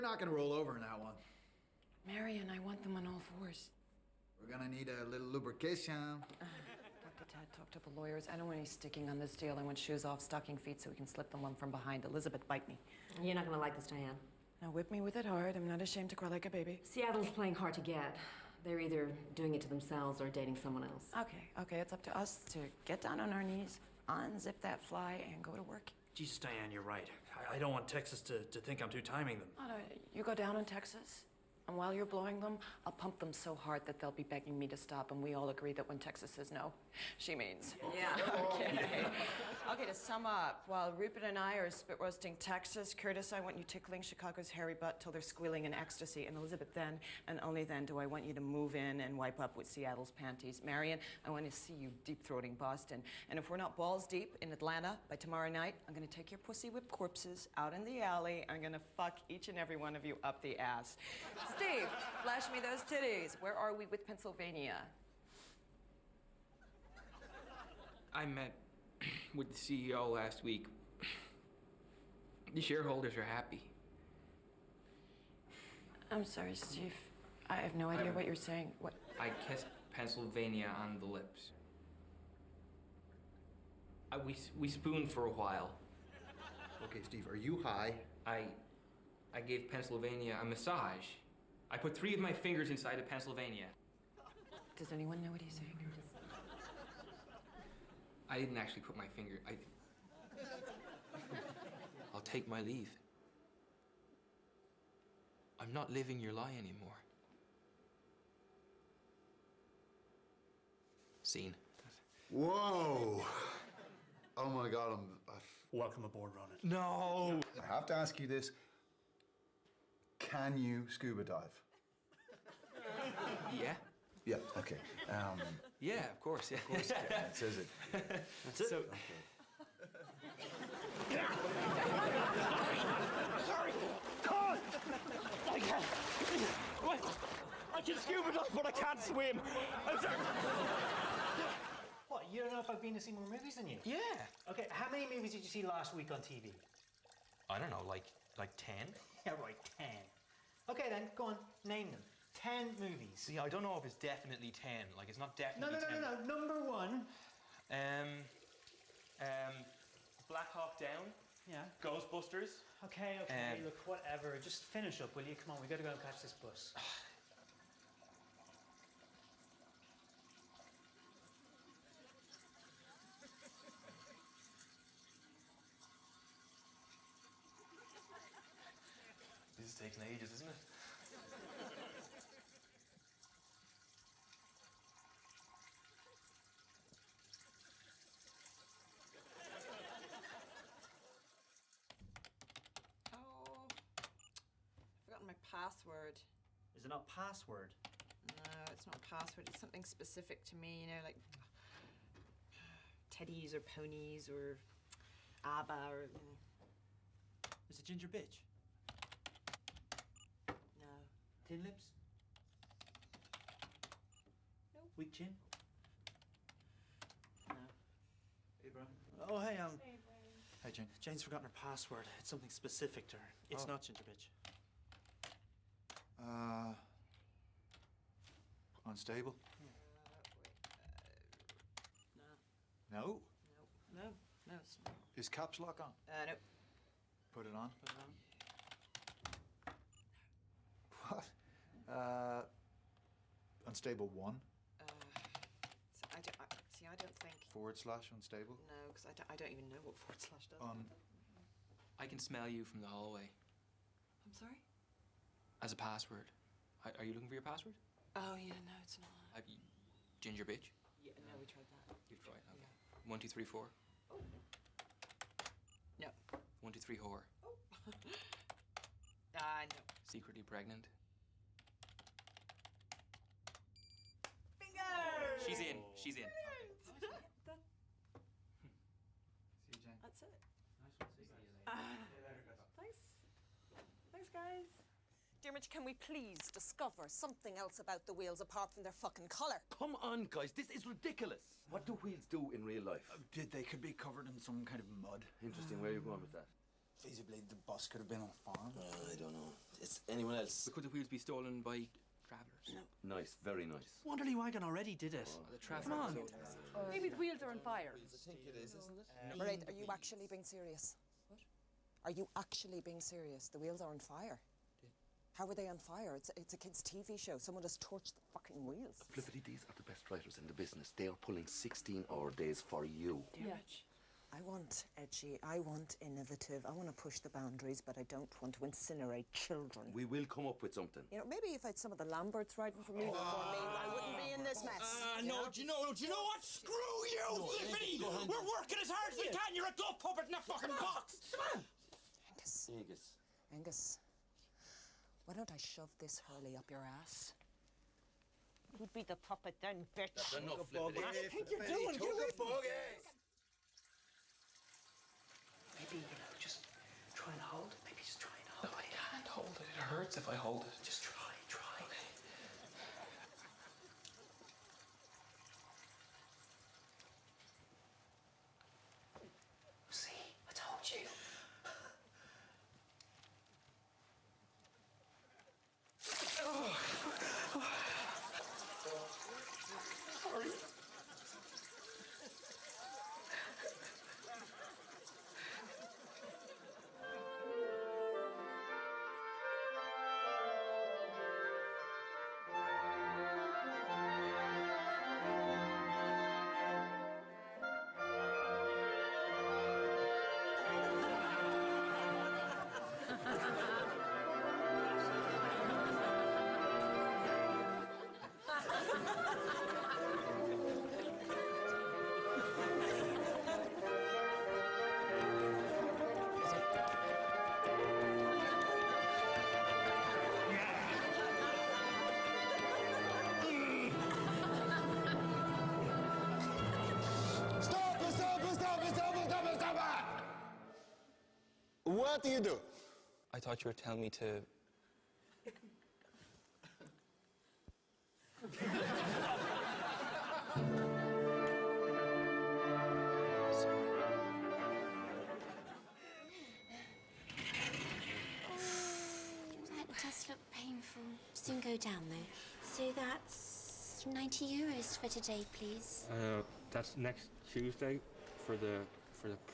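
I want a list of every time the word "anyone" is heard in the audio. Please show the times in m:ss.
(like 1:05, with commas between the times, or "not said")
1:34, 5:00.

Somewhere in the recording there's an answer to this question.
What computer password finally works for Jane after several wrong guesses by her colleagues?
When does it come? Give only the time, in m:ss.
4:30.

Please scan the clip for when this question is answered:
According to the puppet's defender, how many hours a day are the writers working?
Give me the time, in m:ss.
5:21.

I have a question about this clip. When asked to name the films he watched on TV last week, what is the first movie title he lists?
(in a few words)
Black Hawk Down.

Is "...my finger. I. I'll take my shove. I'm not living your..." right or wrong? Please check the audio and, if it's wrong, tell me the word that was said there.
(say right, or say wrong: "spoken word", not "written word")
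wrong: "leave", not "shove".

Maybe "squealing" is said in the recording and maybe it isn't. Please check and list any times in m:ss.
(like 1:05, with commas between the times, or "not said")
0:45.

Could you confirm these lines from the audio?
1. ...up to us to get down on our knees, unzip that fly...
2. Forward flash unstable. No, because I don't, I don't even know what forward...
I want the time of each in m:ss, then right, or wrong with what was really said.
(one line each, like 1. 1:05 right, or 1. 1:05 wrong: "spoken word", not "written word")
1. 0:21 right
2. 4:07 wrong: "slash", not "flash".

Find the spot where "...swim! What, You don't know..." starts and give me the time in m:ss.
2:18.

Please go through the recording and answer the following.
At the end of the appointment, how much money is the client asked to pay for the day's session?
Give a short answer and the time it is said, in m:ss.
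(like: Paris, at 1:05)
90 euros, at 7:34.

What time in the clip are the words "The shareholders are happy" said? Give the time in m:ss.
1:12.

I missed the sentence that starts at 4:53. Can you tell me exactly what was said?
Uh, did they could be covered in some kind of mud.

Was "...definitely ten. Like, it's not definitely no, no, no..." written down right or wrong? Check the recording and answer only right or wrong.
right.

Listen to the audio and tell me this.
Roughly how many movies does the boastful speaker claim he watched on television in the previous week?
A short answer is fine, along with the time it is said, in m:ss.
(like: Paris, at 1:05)
10, at 2:28.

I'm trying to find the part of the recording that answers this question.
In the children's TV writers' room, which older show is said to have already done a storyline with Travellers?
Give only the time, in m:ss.
5:04.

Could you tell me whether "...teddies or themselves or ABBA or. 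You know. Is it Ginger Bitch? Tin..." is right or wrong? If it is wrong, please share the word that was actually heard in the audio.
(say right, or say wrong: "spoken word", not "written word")
wrong: "ponies", not "themselves".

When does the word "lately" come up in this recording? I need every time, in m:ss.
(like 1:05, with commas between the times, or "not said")
not said.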